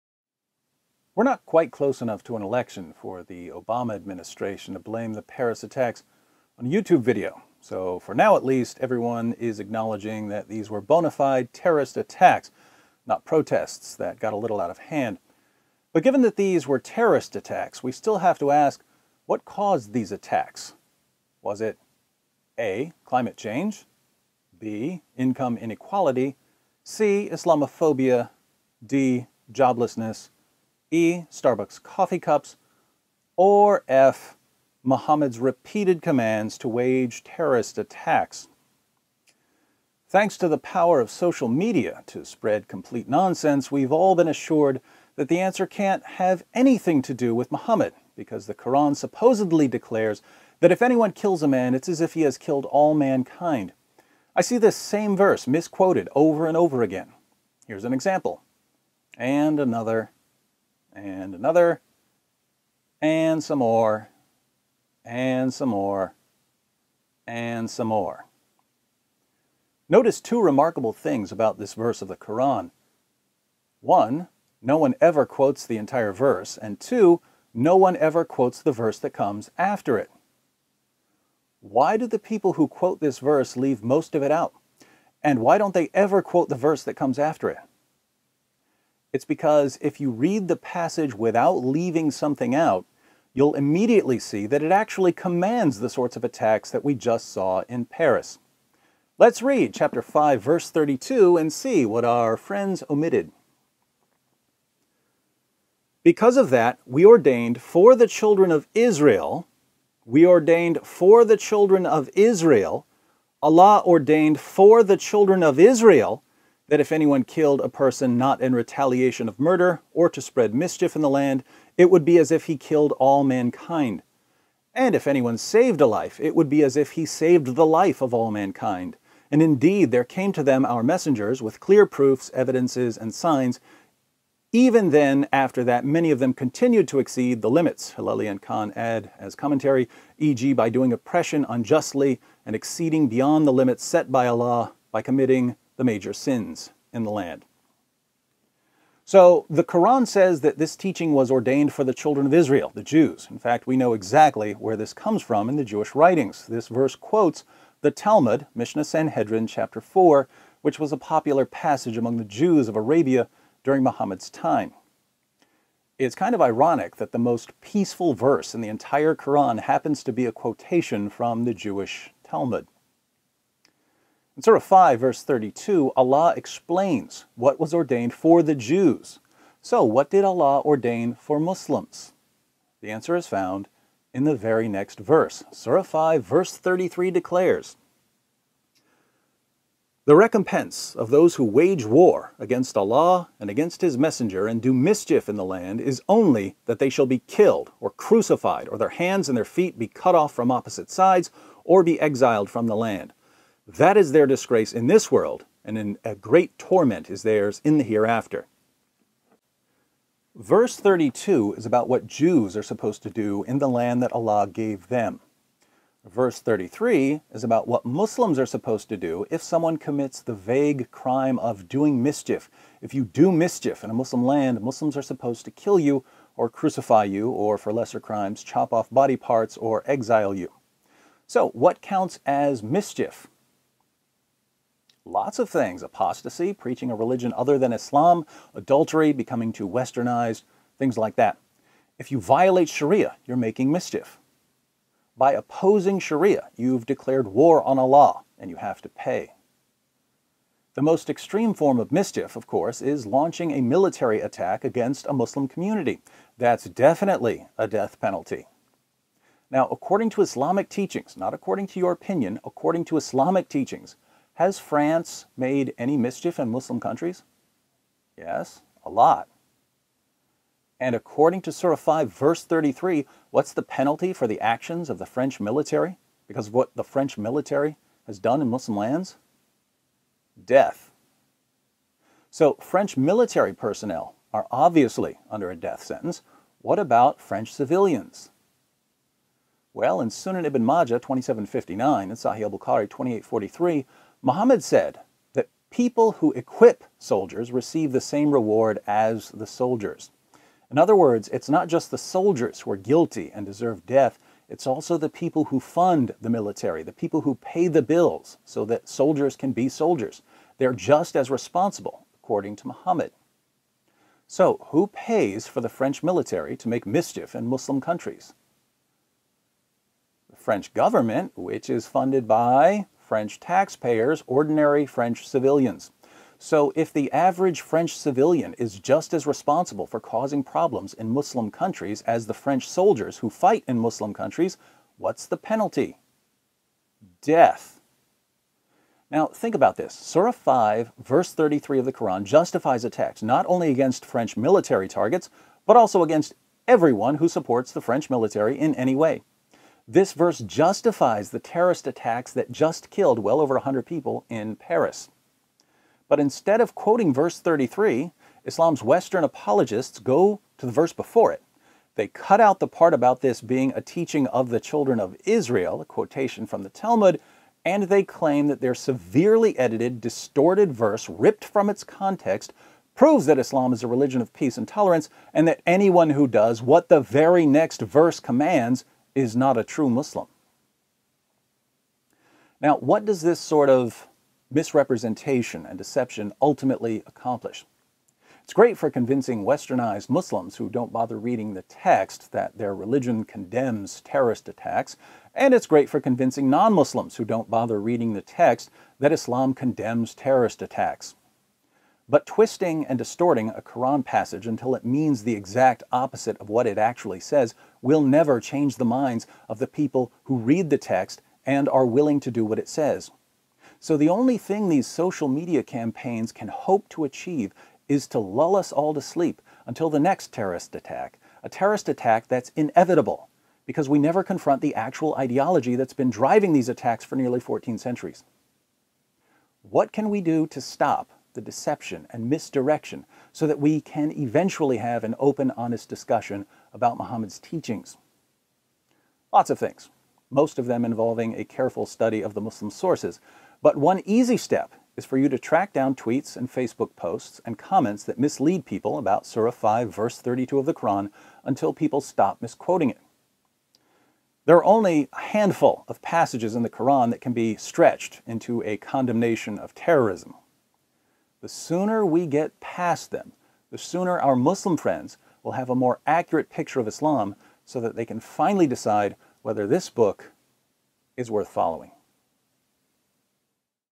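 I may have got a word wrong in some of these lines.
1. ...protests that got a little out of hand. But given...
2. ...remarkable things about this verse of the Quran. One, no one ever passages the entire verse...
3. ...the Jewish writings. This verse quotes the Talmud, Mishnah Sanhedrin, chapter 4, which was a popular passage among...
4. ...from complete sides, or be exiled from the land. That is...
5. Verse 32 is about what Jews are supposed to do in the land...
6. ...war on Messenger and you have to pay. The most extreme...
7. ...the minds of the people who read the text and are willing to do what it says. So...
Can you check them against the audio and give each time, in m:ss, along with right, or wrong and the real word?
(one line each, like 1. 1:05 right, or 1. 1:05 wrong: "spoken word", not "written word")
1. 0:13 right
2. 1:10 wrong: "quotes", not "passages"
3. 2:35 right
4. 3:20 wrong: "opposite", not "complete"
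5. 3:30 right
6. 4:07 wrong: "Allah", not "Messenger"
7. 6:48 right.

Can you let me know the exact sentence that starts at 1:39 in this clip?
Let's read chapter 5, verse 32, and see what our friends omitted.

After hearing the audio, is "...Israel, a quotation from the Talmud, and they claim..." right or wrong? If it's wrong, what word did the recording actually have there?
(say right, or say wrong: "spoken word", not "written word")
right.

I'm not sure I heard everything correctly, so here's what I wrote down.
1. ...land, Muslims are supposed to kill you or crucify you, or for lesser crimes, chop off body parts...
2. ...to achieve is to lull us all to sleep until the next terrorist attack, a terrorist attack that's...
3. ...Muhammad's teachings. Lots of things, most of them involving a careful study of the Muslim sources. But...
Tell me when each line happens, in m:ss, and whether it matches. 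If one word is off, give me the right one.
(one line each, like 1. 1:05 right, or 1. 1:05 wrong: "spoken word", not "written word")
1. 3:44 right
2. 6:56 right
3. 7:16 right.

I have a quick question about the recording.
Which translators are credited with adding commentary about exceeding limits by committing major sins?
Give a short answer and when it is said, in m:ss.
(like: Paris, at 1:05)
Hilali and Khan, at 2:17.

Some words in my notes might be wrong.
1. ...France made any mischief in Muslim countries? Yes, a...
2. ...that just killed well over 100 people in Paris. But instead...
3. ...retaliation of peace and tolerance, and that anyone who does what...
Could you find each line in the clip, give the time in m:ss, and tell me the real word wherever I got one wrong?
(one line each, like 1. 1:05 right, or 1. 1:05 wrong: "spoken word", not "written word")
1. 4:24 right
2. 5:52 right
3. 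6:13 wrong: "religion", not "retaliation".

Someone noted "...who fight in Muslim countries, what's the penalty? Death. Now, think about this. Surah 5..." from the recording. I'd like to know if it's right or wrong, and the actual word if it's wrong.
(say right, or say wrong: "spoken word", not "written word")
right.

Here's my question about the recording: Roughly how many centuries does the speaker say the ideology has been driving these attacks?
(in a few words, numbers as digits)
nearly 14.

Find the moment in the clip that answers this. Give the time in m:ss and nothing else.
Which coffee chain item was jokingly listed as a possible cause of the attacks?
0:31.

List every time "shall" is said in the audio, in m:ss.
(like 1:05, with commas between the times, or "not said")
3:16.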